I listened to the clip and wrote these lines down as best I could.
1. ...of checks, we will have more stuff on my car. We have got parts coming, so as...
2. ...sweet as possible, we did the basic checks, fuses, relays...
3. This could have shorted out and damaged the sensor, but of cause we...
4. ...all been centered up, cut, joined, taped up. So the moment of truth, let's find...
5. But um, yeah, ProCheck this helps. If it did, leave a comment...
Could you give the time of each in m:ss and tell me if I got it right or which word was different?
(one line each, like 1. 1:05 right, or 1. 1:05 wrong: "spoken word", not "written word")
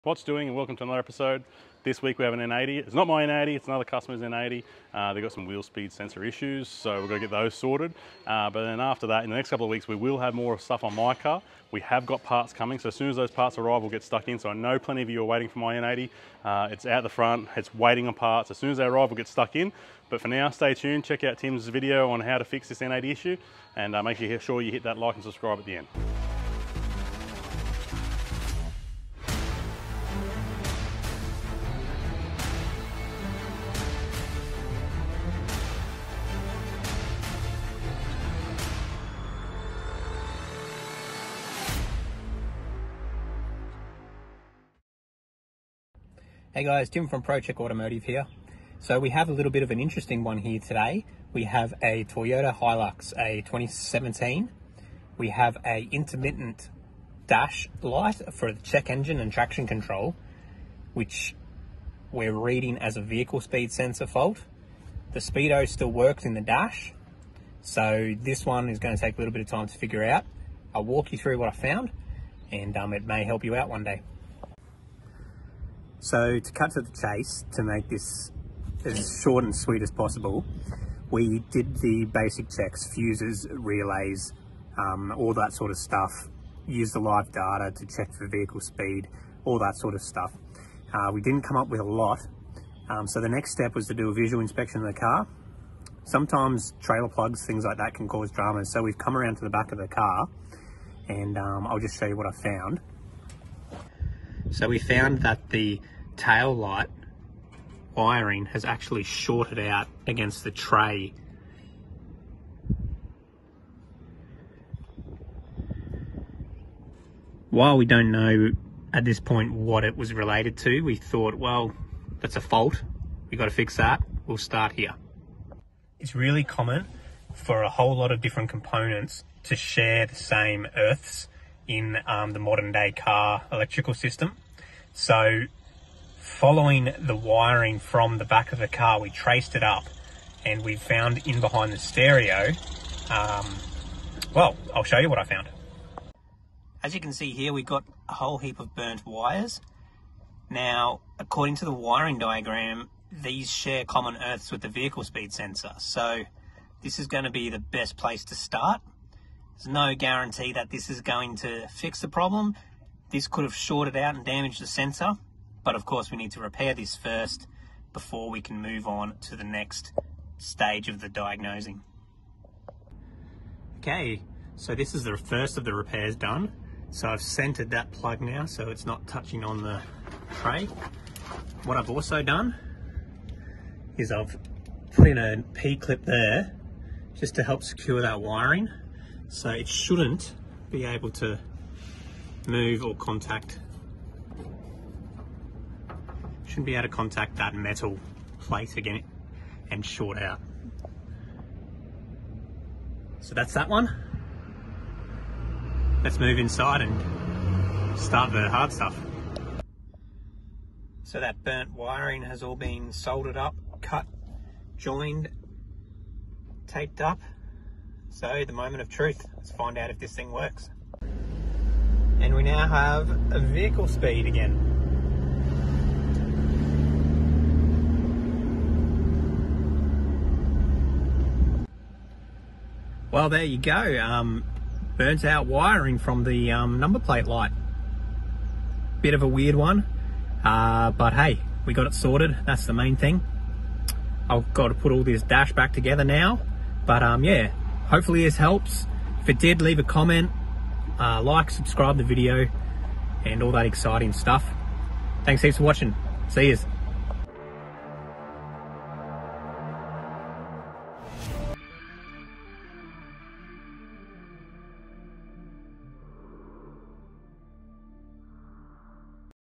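1. 0:09 wrong: "weeks", not "checks"
2. 1:19 right
3. 2:43 wrong: "course", not "cause"
4. 3:32 wrong: "soldered", not "centered"
5. 4:06 wrong: "Hopefully", not "ProCheck".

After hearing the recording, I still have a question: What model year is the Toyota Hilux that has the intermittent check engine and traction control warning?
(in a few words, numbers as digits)
2017.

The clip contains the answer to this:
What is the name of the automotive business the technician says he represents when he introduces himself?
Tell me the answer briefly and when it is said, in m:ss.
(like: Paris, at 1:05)
ProCheck Automotive, at 0:47.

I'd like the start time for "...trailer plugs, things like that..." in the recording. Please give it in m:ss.
1:36.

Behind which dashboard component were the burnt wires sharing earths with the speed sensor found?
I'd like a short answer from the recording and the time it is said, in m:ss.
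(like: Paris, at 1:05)
The stereo, at 2:21.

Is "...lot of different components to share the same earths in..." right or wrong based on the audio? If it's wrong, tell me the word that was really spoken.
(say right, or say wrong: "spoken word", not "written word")
right.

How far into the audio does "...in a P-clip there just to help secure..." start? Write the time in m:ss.
3:05.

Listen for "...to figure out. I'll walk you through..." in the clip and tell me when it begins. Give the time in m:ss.
1:09.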